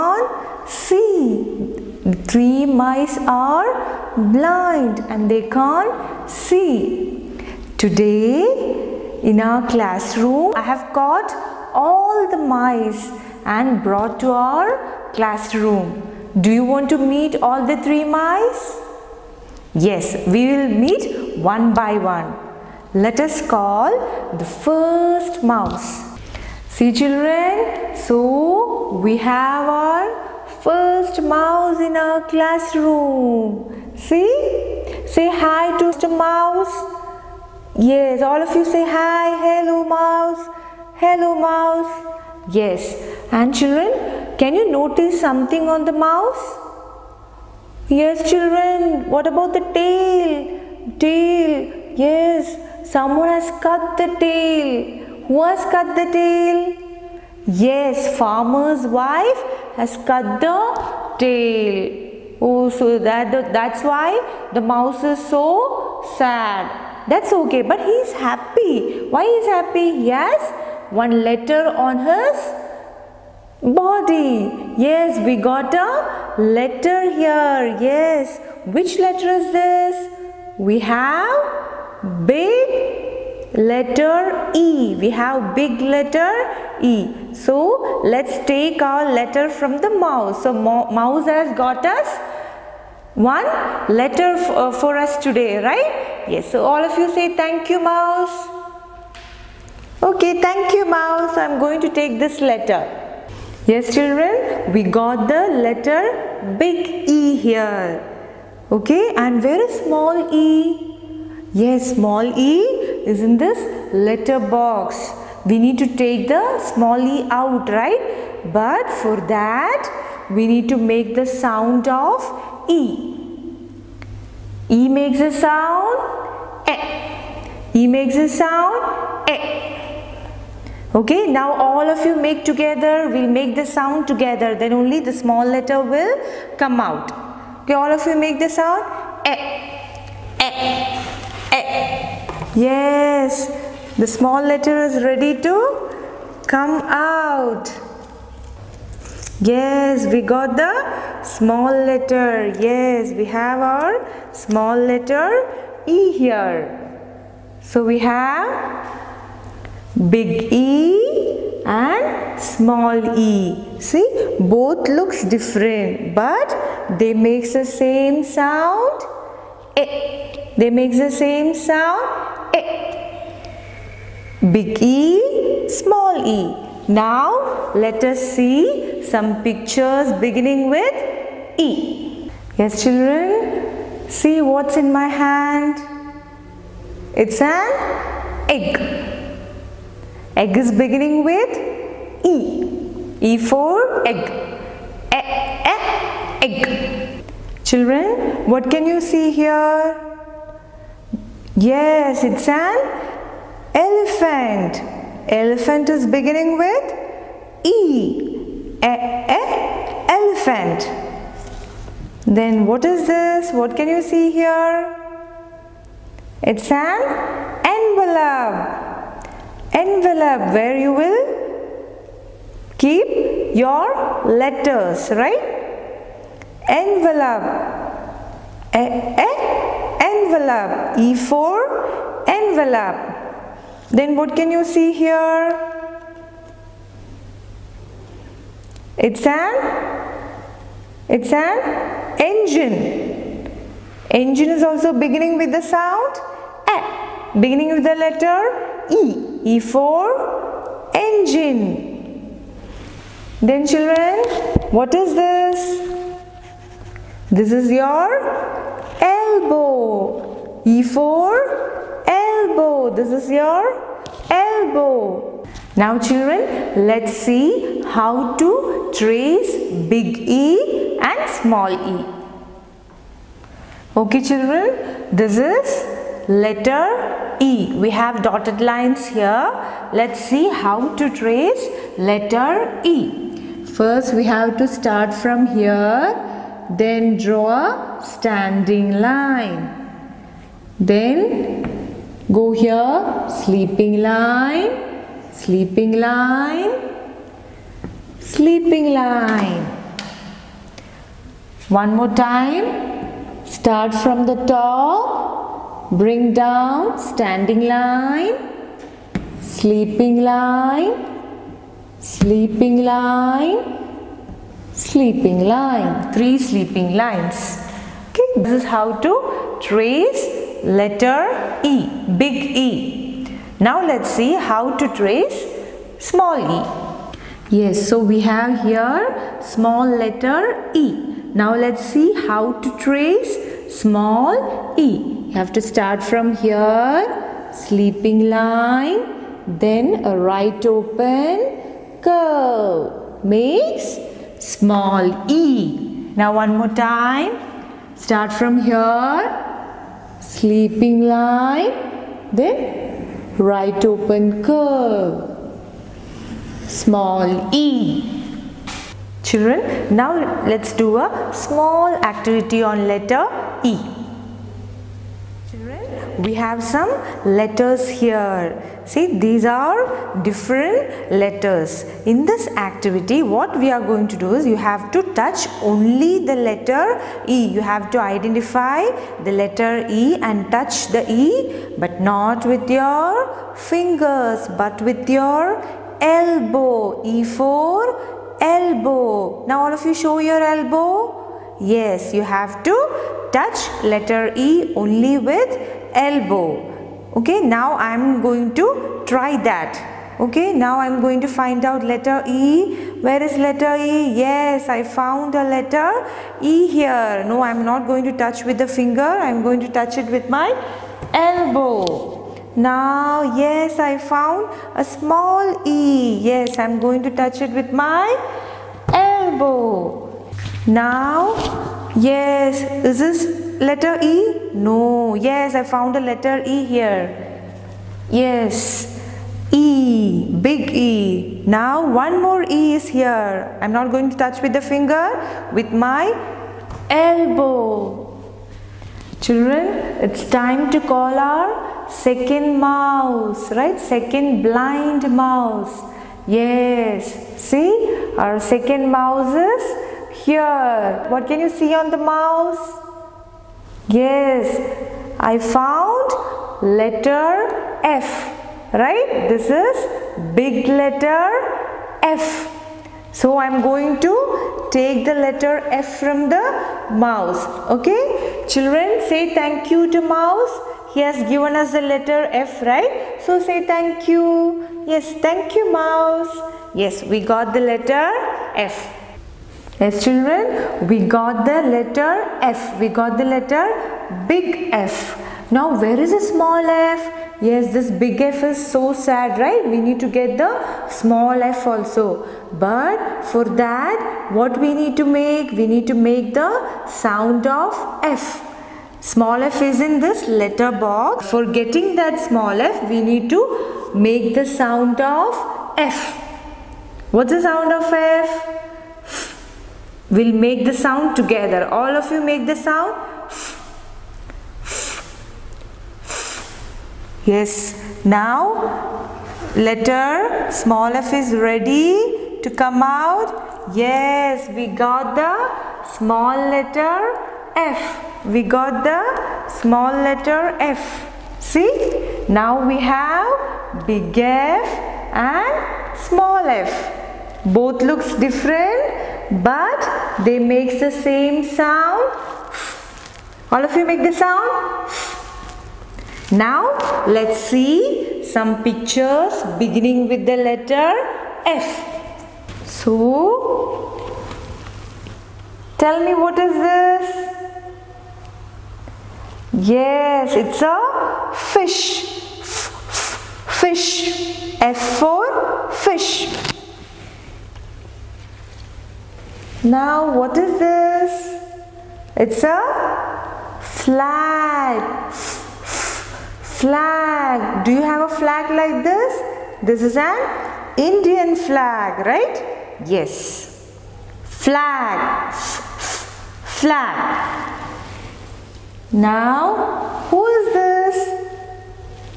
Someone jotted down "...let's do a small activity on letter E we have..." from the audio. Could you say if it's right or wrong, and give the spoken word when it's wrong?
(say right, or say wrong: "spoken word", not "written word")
right.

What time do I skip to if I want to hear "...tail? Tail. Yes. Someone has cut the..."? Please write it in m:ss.
0:49.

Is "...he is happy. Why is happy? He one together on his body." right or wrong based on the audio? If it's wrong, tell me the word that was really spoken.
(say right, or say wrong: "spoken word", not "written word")
wrong: "letter", not "together".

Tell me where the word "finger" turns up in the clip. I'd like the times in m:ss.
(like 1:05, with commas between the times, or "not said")
6:23, 6:48, 7:14.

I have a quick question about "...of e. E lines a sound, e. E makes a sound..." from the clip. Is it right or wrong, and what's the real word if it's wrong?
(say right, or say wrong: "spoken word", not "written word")
wrong: "makes", not "lines".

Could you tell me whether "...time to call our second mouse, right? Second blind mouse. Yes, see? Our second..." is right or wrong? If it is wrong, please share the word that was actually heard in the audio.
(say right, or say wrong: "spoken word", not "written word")
right.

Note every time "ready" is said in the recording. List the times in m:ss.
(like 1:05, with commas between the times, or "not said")
2:25, 8:41.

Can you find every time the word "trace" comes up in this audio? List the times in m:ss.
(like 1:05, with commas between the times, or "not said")
4:28, 4:41, 5:19, 5:24, 5:32.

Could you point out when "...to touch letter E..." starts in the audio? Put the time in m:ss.
6:32.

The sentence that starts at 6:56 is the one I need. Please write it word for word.
Yes, I'm going to touch it with my elbow.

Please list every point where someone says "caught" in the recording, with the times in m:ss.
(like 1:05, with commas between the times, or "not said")
0:10.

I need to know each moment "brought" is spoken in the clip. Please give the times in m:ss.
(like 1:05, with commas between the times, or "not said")
0:13.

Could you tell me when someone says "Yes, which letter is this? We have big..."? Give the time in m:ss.
1:17.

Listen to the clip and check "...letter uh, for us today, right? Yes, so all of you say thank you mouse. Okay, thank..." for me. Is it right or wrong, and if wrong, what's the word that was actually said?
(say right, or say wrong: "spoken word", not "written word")
right.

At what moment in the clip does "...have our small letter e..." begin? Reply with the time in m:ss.
2:33.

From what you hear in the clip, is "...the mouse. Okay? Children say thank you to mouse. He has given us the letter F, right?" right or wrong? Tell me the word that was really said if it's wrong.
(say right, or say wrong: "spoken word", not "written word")
right.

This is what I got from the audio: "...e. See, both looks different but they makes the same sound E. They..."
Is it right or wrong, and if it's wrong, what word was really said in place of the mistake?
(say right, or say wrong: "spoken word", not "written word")
right.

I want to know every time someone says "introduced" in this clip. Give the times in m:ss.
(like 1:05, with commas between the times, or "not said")
not said.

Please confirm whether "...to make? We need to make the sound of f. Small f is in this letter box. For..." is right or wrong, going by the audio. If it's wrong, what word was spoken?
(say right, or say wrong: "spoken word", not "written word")
right.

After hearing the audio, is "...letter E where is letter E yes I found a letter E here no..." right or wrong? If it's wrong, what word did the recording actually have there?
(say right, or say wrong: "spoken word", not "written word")
right.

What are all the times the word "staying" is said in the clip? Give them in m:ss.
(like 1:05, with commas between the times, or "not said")
not said.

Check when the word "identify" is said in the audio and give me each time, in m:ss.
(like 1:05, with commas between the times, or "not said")
6:17.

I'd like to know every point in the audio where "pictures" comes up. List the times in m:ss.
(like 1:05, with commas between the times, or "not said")
2:59, 9:08.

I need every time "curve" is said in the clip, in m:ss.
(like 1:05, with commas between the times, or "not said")
5:42, 5:54.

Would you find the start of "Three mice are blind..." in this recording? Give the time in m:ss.
0:02.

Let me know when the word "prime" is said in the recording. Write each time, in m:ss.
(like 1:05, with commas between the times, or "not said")
not said.